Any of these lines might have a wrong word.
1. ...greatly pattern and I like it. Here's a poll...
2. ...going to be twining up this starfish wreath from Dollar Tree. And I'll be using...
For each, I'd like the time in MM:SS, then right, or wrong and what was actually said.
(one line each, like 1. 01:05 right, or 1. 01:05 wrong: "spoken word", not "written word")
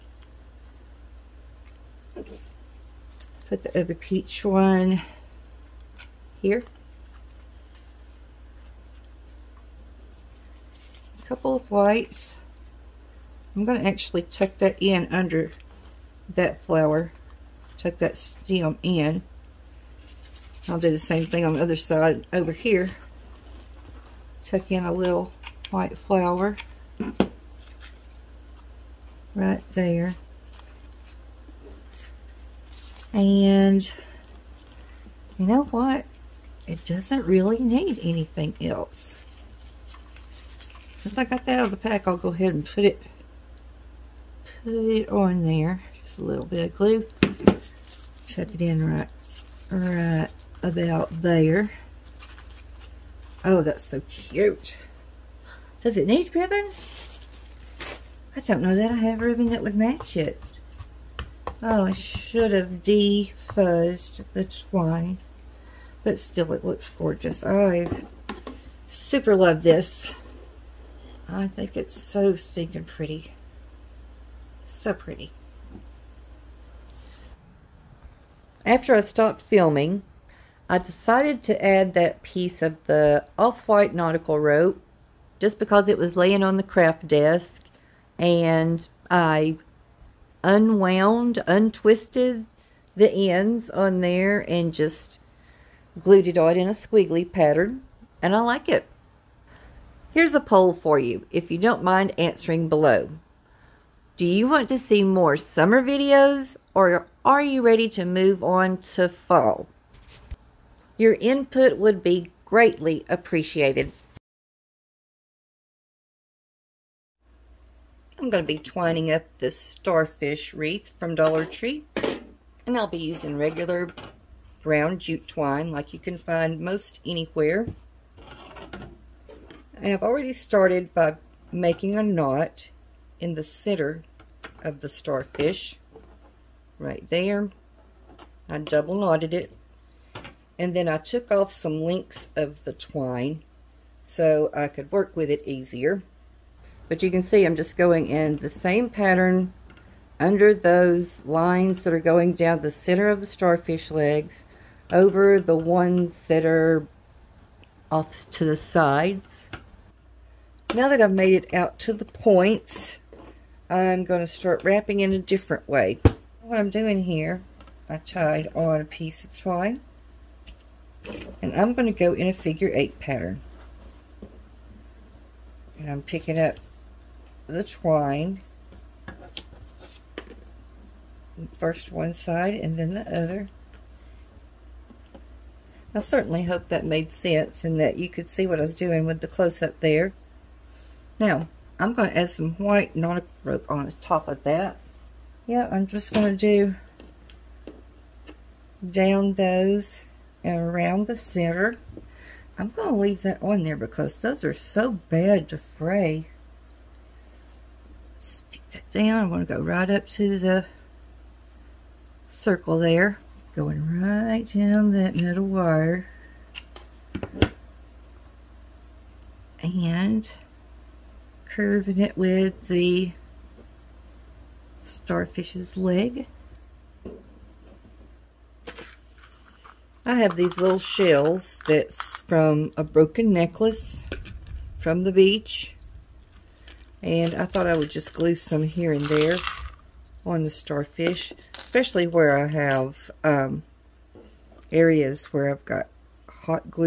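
1. 01:36 wrong: "squiggly", not "greatly"
2. 01:58 right.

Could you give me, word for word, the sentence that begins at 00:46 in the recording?
Just a little bit of glue.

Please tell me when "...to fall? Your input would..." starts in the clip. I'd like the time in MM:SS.
01:48.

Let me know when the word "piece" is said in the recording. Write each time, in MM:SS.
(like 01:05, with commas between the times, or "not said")
01:22, 02:48.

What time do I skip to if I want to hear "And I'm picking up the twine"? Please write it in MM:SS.
02:55.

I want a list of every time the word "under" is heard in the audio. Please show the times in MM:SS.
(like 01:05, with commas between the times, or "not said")
00:15, 02:30.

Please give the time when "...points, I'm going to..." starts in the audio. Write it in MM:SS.
02:42.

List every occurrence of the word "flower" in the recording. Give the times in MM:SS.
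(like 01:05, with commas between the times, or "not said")
00:16, 00:25.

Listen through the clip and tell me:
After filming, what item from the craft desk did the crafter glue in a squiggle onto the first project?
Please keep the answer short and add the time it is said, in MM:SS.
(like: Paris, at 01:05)
off-white nautical rope, at 01:23.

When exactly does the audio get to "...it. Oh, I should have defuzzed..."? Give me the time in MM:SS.
01:00.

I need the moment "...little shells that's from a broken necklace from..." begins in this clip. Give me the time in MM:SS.
03:50.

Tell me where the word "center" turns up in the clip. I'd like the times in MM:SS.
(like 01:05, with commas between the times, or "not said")
02:13, 02:32, 03:21.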